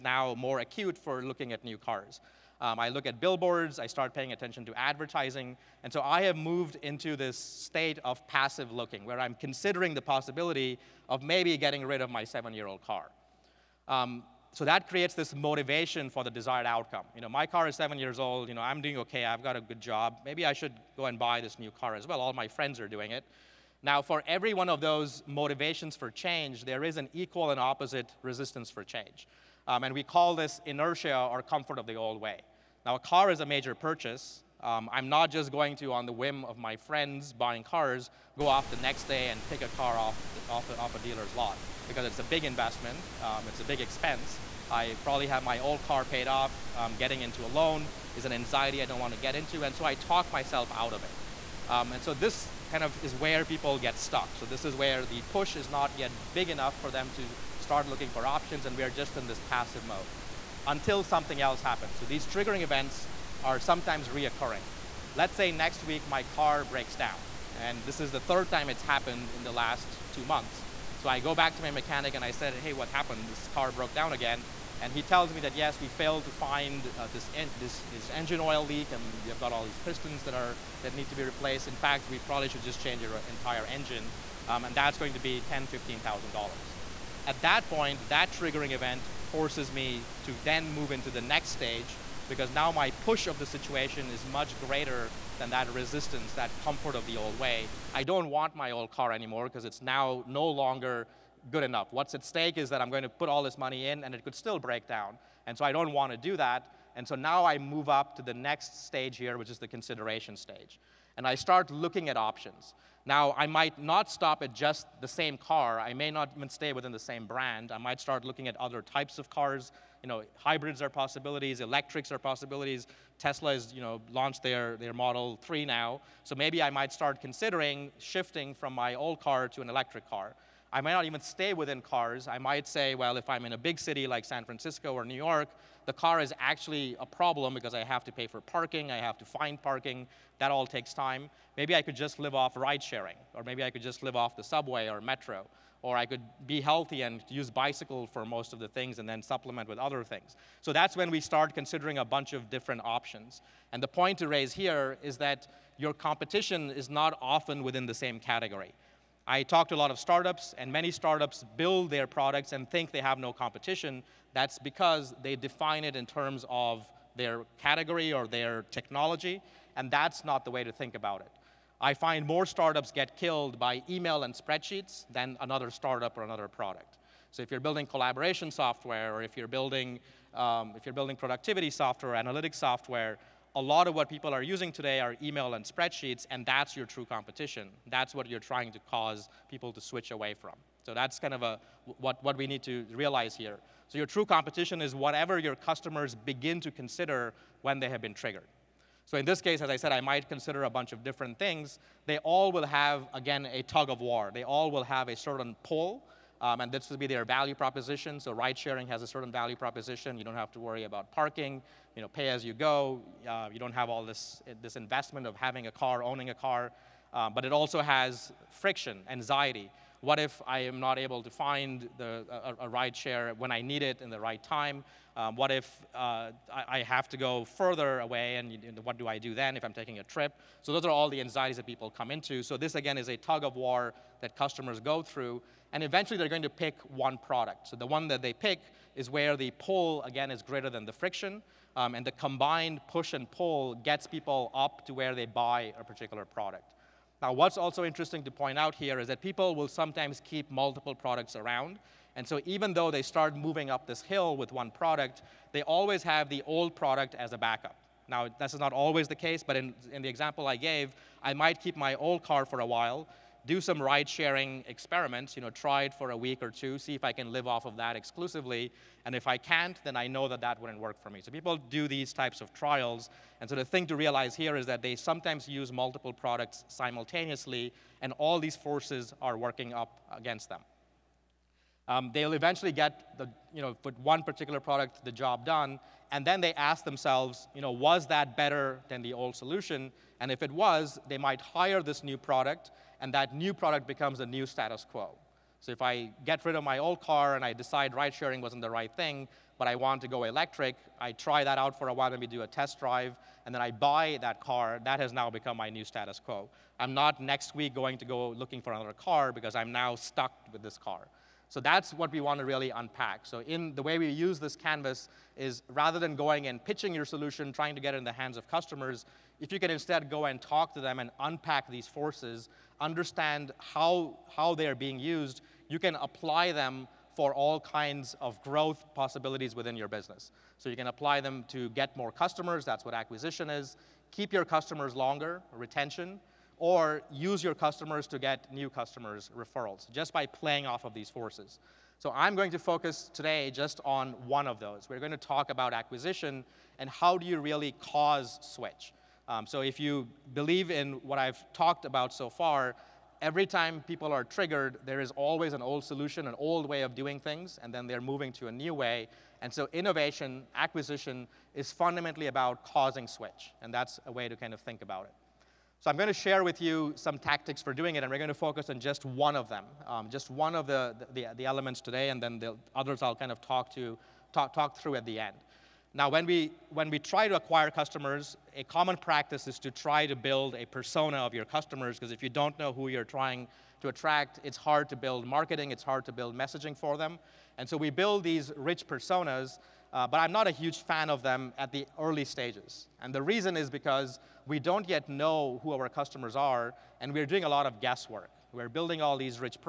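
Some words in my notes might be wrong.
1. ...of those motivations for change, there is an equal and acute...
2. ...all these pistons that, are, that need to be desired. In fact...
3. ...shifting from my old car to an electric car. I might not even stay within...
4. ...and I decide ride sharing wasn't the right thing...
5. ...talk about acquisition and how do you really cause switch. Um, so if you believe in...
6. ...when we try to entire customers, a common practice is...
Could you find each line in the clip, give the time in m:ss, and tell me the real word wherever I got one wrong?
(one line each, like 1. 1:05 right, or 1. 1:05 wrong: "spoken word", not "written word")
1. 0:24 wrong: "opposite", not "acute"
2. 1:19 wrong: "replaced", not "desired"
3. 2:07 right
4. 4:57 right
5. 5:45 right
6. 6:16 wrong: "acquire", not "entire".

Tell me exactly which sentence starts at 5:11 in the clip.
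So that's what we want to really unpack.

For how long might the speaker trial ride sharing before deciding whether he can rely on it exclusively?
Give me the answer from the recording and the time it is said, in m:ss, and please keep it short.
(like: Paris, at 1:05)
a week or two, at 4:26.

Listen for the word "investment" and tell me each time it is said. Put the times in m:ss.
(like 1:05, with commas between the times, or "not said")
0:42, 3:34.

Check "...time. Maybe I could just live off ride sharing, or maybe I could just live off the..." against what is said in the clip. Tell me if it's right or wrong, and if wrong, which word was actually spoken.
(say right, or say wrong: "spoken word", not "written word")
right.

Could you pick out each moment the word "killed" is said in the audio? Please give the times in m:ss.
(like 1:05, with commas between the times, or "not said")
2:53.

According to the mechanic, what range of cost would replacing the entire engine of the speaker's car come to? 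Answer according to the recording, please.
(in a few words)
$10,000 to $15,000.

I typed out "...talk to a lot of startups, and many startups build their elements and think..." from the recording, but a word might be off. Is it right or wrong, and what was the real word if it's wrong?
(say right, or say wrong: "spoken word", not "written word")
wrong: "products", not "elements".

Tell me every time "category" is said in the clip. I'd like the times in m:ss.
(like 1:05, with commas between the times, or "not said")
2:38, 2:47.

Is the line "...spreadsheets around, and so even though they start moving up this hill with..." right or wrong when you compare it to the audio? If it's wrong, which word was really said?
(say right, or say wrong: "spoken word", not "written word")
wrong: "products", not "spreadsheets".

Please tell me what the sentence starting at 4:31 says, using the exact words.
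So people do these types of trials.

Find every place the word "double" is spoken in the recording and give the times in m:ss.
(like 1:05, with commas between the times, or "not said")
not said.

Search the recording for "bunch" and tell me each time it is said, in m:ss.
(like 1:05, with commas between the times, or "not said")
2:32, 3:20.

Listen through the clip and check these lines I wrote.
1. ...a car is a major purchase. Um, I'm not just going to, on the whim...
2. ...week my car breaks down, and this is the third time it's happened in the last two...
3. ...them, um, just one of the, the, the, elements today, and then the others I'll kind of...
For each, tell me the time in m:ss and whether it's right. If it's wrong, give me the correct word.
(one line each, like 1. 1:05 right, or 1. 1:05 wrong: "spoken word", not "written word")
1. 0:32 right
2. 1:05 right
3. 6:09 right.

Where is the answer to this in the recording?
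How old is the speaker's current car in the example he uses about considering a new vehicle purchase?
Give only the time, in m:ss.
0:12.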